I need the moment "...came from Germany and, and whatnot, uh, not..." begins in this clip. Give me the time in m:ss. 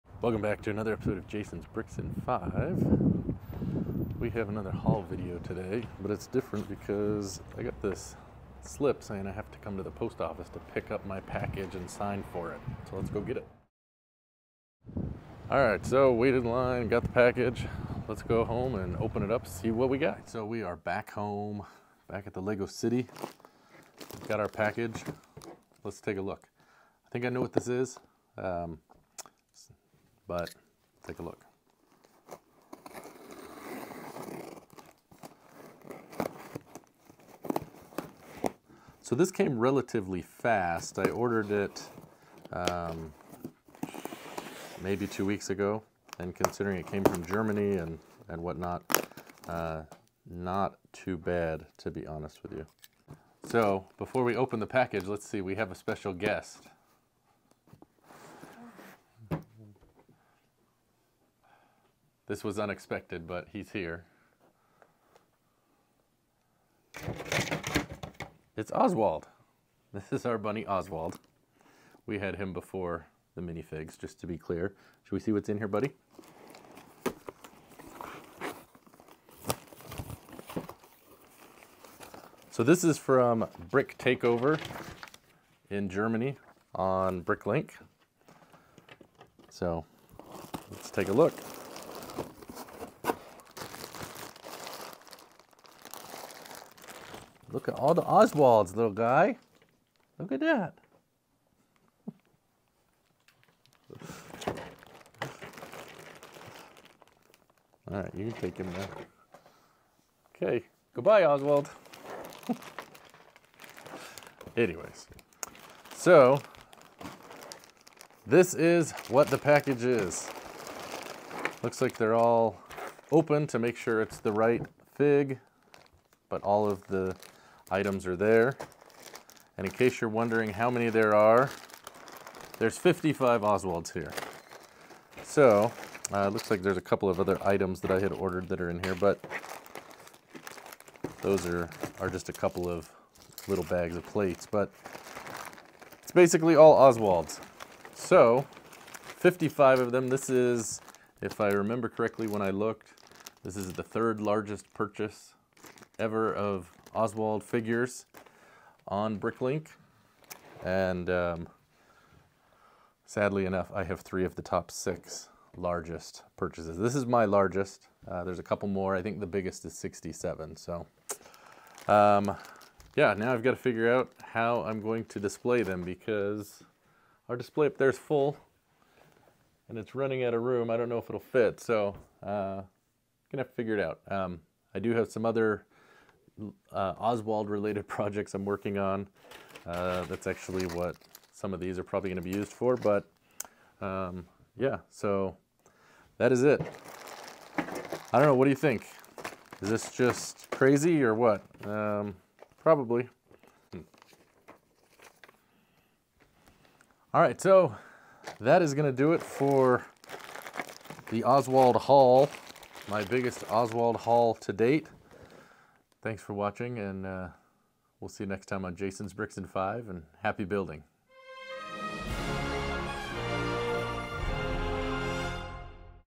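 0:46.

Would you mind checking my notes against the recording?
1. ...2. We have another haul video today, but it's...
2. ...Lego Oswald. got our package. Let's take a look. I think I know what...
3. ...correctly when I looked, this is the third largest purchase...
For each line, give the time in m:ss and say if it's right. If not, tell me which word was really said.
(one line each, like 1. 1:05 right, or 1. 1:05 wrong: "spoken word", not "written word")
1. 0:02 wrong: "5", not "2"
2. 0:22 wrong: "City", not "Oswald"
3. 2:31 right.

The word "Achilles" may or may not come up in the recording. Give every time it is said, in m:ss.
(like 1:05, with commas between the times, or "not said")
not said.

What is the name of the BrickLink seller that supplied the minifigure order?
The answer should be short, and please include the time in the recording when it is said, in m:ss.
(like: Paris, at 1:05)
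Brick Takeover, at 1:23.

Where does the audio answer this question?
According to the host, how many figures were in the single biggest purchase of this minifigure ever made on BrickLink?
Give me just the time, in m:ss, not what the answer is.
2:49.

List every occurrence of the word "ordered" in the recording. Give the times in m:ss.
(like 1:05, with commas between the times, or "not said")
0:41, 2:18.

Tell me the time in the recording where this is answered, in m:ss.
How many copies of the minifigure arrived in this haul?
2:12.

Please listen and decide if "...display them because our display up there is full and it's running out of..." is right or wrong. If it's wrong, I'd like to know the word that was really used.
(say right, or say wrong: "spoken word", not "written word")
right.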